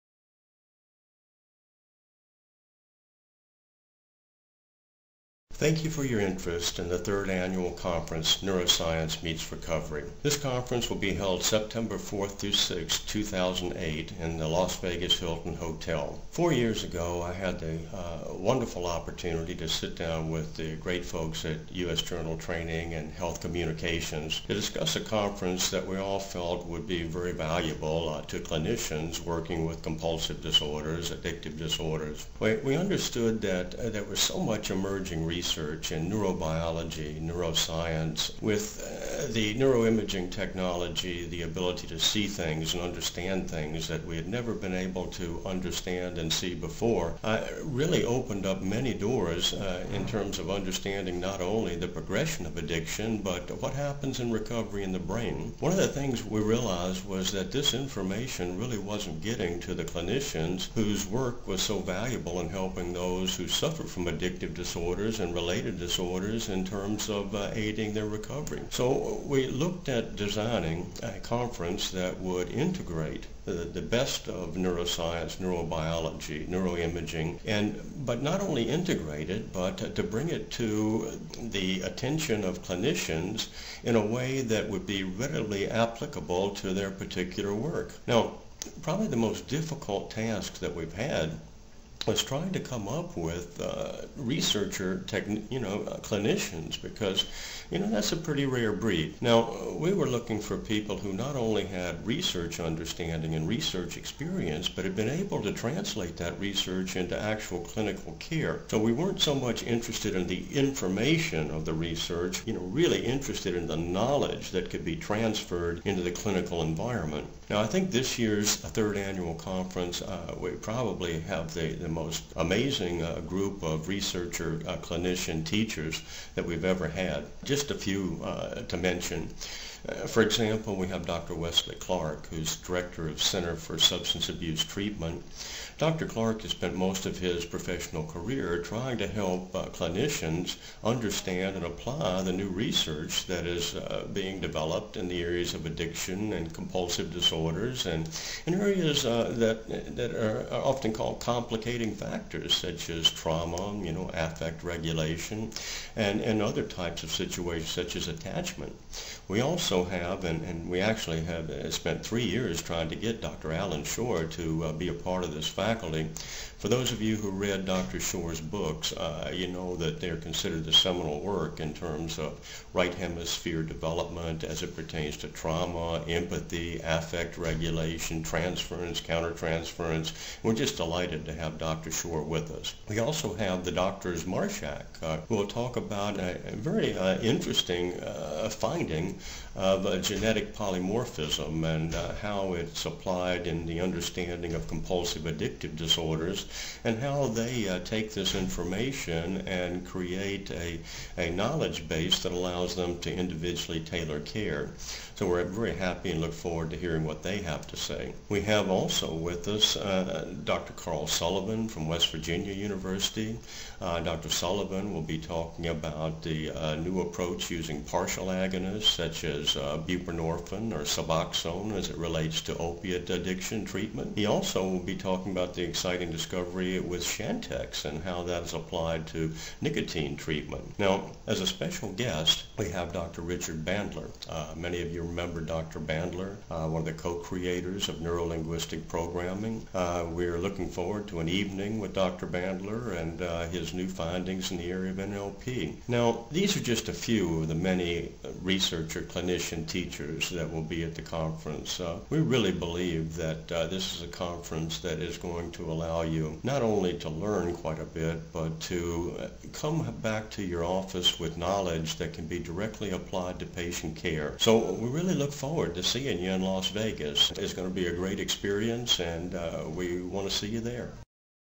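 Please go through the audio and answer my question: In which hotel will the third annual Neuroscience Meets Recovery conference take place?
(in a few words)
Las Vegas Hilton.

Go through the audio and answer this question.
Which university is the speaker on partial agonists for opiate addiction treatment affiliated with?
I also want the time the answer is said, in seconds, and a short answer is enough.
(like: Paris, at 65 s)
West Virginia University, at 211 s.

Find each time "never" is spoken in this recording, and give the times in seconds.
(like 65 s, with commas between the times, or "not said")
44 s.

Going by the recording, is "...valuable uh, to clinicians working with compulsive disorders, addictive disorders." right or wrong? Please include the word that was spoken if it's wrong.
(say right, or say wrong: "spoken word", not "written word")
right.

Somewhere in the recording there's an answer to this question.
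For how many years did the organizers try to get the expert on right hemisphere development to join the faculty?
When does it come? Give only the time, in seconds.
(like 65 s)
162 s.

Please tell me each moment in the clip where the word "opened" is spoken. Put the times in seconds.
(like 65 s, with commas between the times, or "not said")
48 s.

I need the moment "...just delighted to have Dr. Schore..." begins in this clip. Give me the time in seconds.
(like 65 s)
180 s.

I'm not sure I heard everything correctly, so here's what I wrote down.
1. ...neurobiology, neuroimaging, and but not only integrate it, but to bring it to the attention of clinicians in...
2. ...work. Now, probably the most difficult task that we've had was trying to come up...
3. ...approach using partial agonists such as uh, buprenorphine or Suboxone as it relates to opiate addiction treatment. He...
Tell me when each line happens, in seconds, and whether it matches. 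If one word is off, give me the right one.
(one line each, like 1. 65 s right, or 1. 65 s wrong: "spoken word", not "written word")
1. 75 s right
2. 87 s right
3. 217 s right.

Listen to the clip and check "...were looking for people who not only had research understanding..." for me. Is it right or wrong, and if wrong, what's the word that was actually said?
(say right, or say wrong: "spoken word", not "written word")
right.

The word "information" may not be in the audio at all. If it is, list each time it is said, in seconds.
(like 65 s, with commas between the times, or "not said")
57 s, 110 s, 198 s.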